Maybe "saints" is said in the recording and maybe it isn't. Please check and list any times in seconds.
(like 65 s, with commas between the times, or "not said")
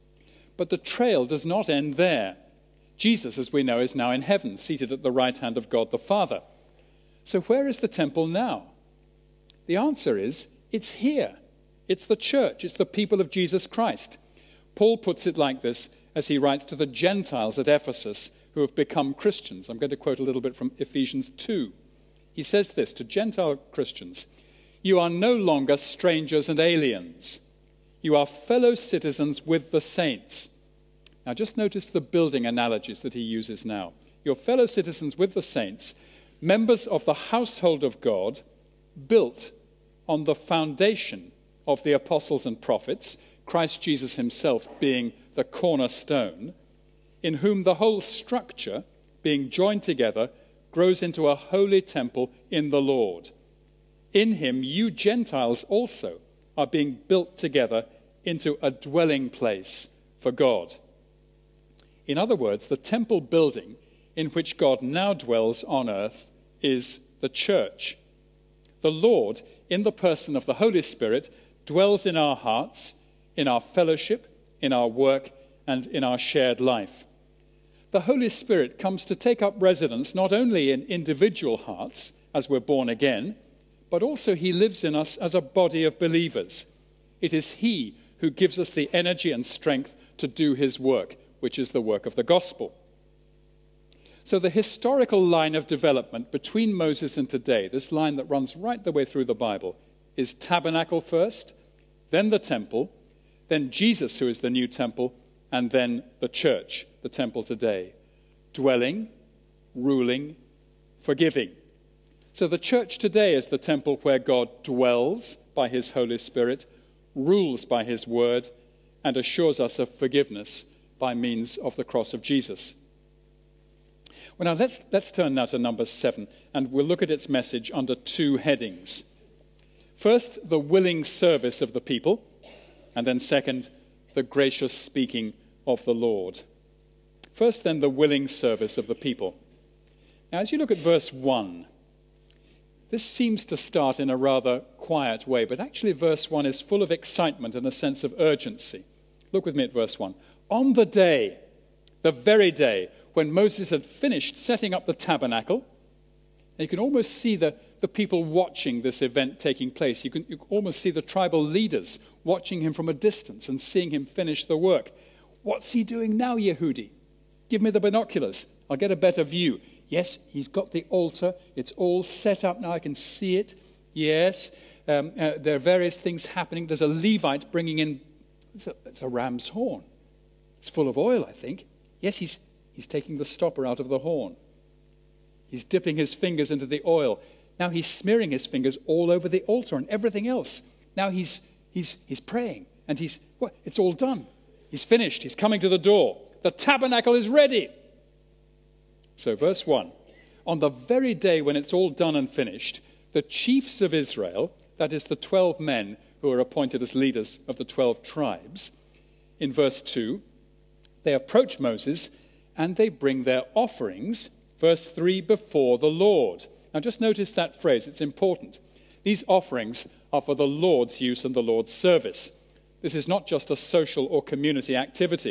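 29 s, 35 s.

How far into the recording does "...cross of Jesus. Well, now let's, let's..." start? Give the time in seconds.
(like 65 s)
121 s.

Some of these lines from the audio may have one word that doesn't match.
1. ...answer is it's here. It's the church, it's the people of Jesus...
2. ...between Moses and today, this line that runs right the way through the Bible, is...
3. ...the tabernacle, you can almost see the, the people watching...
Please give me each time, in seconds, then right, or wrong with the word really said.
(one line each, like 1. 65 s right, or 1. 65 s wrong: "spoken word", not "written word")
1. 9 s right
2. 96 s right
3. 154 s right.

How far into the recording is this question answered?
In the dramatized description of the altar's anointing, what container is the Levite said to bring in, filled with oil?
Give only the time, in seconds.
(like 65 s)
179 s.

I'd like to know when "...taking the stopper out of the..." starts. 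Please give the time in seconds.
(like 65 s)
182 s.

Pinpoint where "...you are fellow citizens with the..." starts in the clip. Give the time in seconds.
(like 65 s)
28 s.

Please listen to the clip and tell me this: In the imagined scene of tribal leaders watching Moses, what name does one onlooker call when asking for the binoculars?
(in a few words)
Yehudi.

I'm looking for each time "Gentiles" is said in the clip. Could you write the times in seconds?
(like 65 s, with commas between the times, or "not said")
16 s, 23 s, 54 s.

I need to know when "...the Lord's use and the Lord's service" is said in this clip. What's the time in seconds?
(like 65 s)
220 s.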